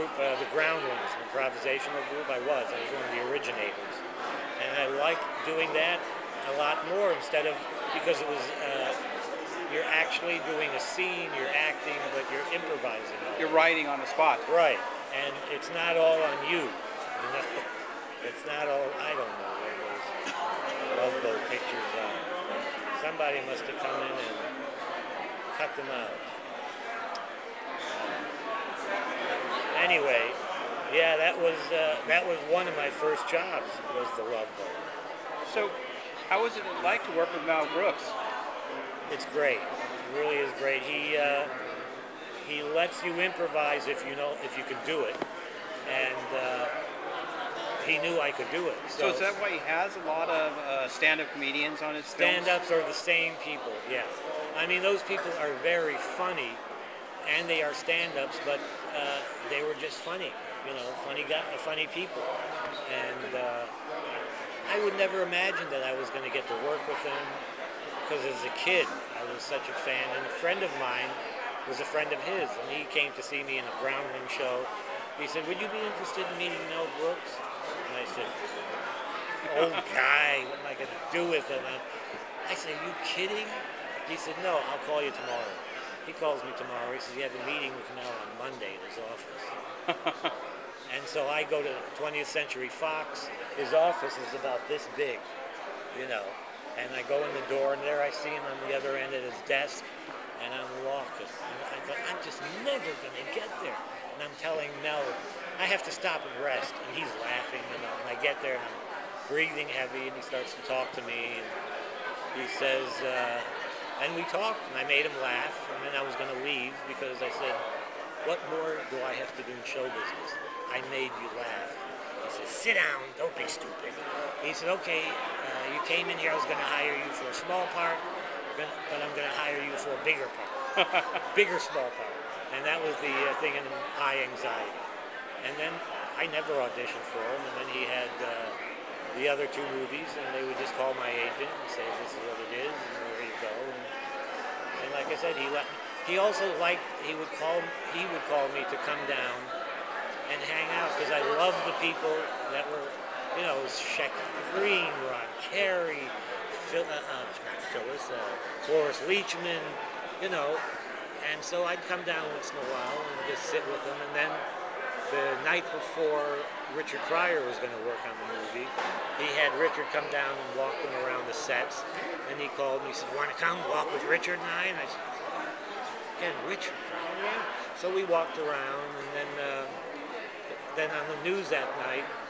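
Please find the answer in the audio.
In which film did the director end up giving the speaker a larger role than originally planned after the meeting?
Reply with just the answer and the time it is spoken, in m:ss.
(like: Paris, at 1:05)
High Anxiety, at 2:13.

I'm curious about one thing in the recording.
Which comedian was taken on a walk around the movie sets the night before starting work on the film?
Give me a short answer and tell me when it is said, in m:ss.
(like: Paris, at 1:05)
Richard Pryor, at 2:46.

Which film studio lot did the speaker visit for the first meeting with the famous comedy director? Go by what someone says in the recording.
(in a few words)
20th Century Fox.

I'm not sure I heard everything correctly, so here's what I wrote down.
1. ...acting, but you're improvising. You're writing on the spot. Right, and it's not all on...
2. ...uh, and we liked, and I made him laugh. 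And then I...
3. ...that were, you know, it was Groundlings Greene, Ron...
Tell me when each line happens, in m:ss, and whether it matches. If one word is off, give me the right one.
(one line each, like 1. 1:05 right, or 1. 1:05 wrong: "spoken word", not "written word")
1. 0:11 right
2. 1:53 wrong: "talked", not "liked"
3. 2:32 wrong: "Shecky", not "Groundlings".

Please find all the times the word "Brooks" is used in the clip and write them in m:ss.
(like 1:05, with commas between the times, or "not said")
0:37, 1:17.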